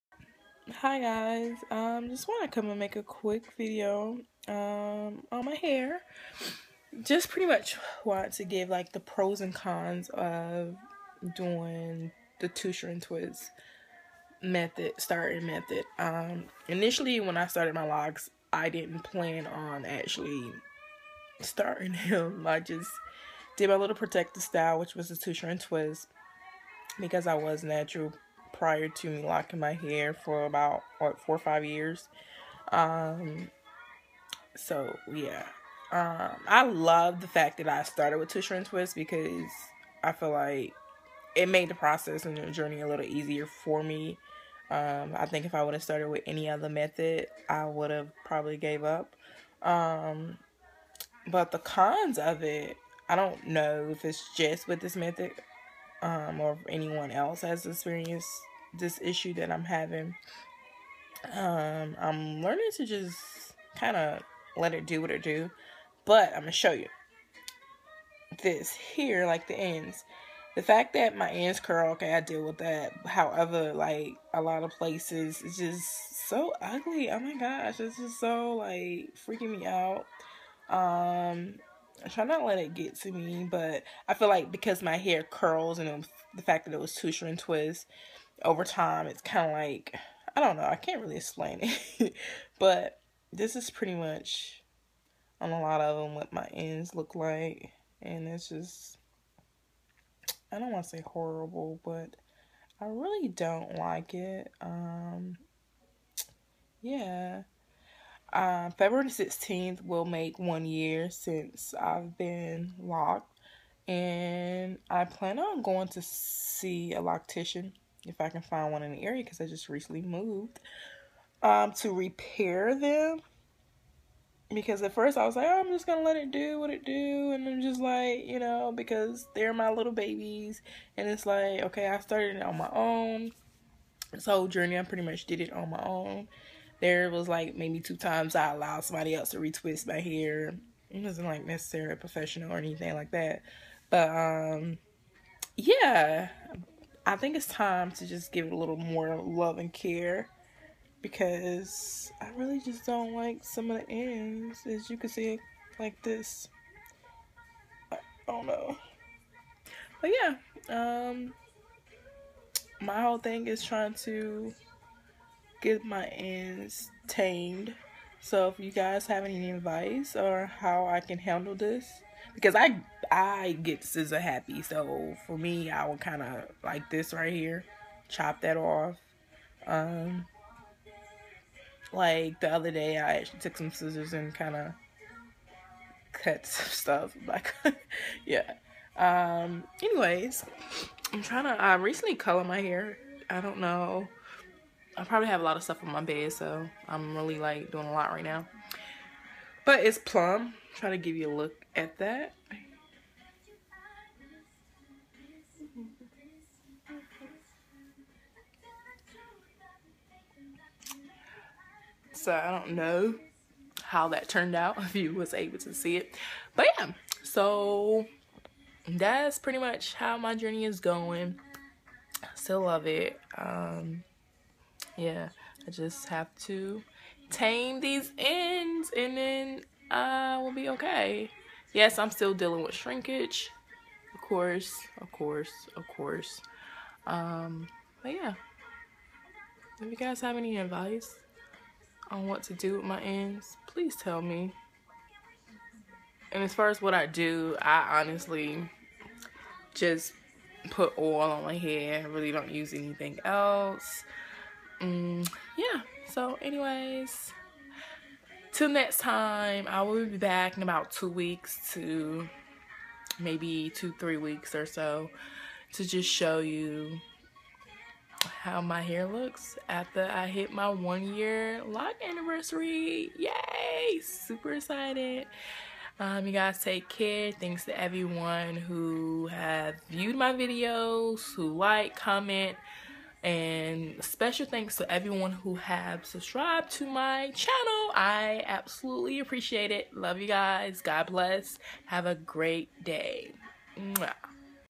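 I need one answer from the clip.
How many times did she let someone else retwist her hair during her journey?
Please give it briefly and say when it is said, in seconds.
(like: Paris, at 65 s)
2, at 137 s.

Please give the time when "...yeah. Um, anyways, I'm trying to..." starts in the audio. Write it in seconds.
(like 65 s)
188 s.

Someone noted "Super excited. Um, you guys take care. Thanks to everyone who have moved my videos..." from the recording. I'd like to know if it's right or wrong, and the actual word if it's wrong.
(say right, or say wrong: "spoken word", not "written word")
wrong: "viewed", not "moved".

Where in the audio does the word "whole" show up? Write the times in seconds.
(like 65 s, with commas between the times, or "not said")
134 s, 163 s.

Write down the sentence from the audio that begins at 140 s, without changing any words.
It wasn't like necessarily professional or anything like that.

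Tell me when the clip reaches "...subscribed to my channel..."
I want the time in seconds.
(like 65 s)
286 s.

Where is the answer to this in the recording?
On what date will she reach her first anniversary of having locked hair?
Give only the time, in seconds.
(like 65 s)
108 s.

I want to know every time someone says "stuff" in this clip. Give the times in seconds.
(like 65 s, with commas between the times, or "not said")
186 s, 195 s.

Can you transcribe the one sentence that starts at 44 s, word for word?
Um, I think if I would have started with any other method, I would have probably gave up.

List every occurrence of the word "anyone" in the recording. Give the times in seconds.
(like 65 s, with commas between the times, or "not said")
56 s.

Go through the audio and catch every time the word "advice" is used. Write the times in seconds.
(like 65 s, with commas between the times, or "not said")
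169 s, 240 s.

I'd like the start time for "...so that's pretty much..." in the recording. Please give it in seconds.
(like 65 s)
217 s.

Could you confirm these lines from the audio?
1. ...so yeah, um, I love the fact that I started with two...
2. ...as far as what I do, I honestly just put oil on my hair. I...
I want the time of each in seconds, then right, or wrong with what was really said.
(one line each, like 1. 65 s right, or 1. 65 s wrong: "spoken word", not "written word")
1. 34 s right
2. 246 s right.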